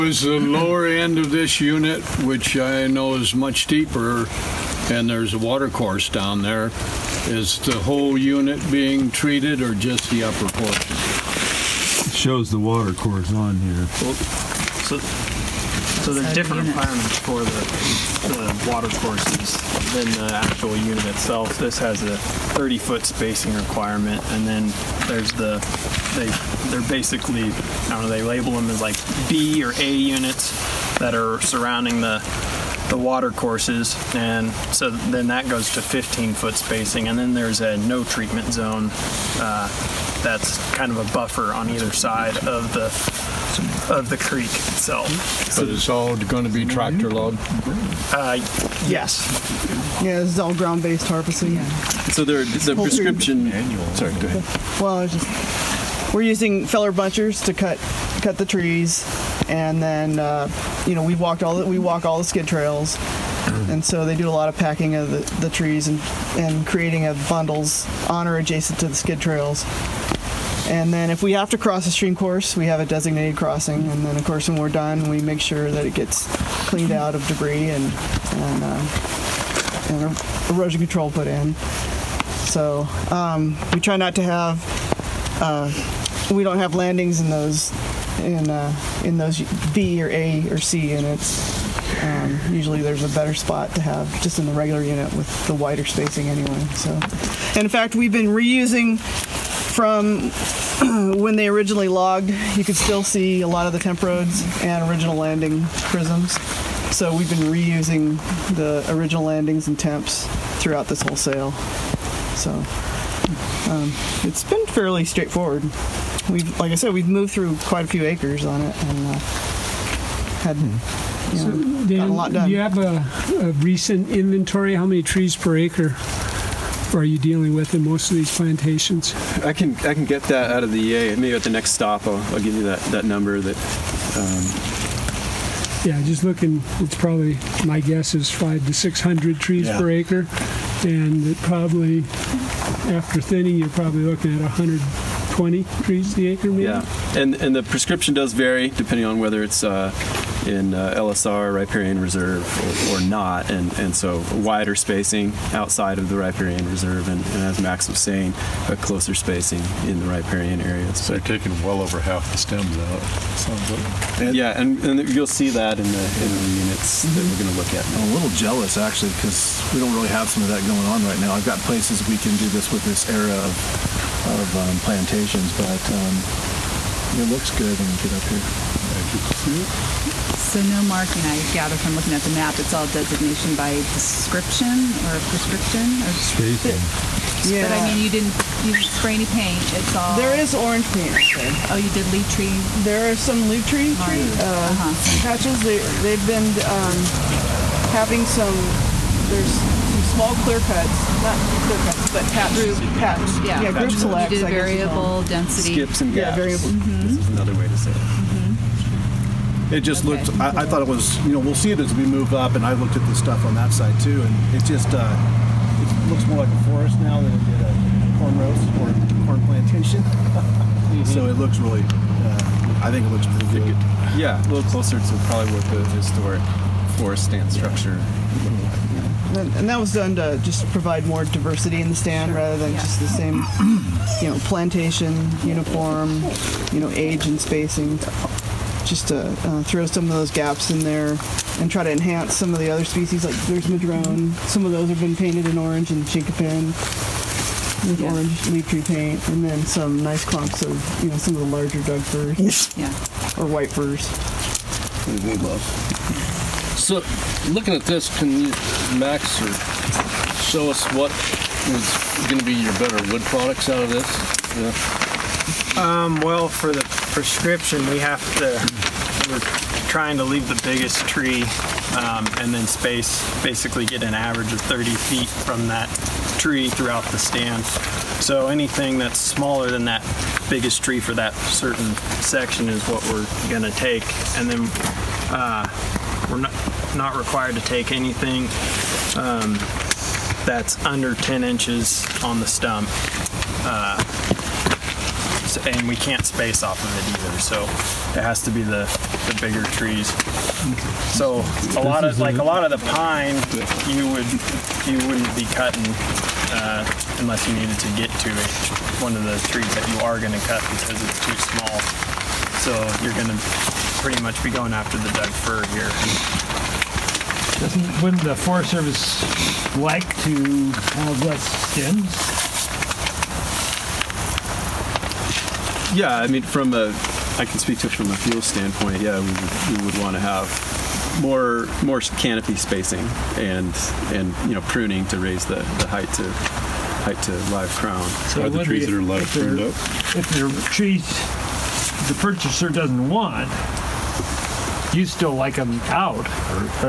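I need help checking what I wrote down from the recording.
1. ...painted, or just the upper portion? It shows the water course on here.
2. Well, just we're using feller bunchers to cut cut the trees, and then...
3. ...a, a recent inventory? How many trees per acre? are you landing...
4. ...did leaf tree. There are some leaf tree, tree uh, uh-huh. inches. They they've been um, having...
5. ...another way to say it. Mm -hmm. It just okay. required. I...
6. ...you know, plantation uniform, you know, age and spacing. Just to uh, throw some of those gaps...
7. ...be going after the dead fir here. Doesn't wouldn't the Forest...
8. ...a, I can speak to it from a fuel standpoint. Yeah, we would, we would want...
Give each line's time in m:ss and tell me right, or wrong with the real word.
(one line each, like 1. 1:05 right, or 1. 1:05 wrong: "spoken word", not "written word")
1. 0:09 wrong: "treated", not "painted"
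2. 0:54 right
3. 2:02 wrong: "dealing", not "landing"
4. 3:11 wrong: "patches", not "inches"
5. 3:27 wrong: "looked", not "required"
6. 3:54 right
7. 5:14 right
8. 5:26 right.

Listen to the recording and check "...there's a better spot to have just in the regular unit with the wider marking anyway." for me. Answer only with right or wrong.
wrong.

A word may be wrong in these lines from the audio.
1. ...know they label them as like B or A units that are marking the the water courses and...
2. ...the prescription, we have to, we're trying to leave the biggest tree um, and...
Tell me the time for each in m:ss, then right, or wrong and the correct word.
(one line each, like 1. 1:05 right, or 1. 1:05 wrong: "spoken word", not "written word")
1. 0:28 wrong: "surrounding", not "marking"
2. 4:26 right.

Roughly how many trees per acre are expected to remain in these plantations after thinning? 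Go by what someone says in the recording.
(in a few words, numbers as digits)
120.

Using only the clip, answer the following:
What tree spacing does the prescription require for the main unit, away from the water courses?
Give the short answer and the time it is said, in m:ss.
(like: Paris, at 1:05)
30 feet, at 0:22.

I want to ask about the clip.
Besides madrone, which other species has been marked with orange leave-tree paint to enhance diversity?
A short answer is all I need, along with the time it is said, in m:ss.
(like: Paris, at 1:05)
Chinkapin, at 4:06.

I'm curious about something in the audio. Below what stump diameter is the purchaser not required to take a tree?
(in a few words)
10 inches.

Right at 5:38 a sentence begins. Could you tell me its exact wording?
So are the trees that are live pruned up?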